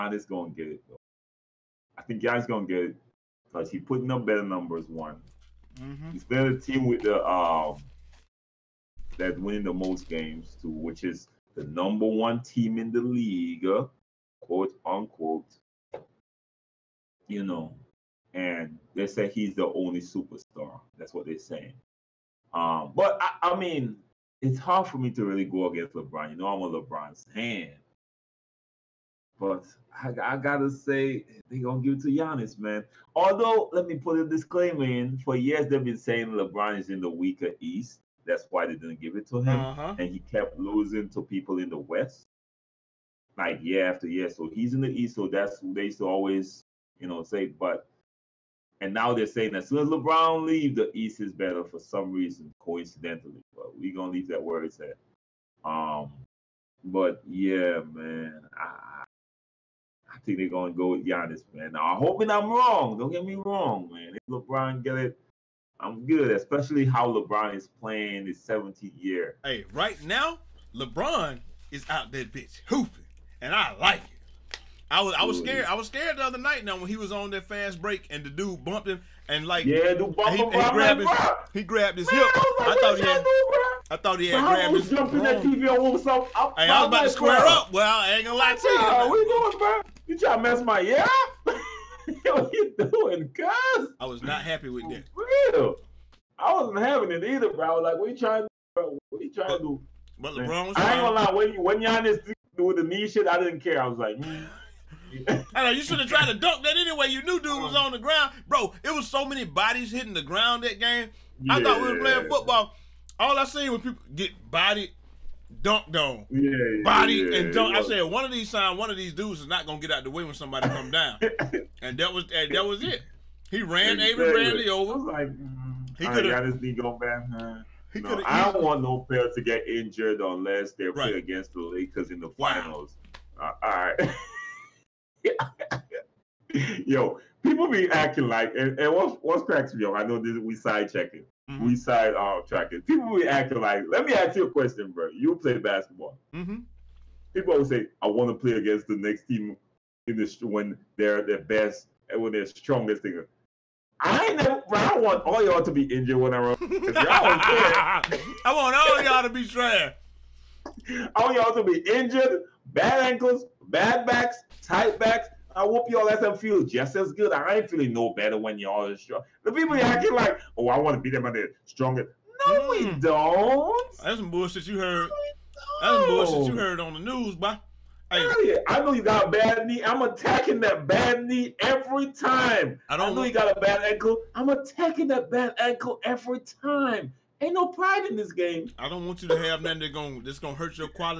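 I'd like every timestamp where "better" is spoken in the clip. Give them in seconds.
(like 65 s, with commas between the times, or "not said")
4 s, 51 s, 168 s.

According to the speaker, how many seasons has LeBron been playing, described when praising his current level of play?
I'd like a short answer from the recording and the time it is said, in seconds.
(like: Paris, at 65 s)
17, at 68 s.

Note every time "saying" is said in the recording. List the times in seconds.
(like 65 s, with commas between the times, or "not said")
21 s, 35 s, 49 s.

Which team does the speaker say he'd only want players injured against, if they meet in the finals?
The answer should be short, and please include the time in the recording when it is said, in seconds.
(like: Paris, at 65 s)
Lakers, at 131 s.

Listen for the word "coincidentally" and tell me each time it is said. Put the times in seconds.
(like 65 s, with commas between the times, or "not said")
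52 s.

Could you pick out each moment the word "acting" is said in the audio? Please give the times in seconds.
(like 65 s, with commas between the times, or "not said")
137 s, 143 s, 169 s.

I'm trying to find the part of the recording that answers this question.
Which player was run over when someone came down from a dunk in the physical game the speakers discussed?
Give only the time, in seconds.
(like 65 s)
124 s.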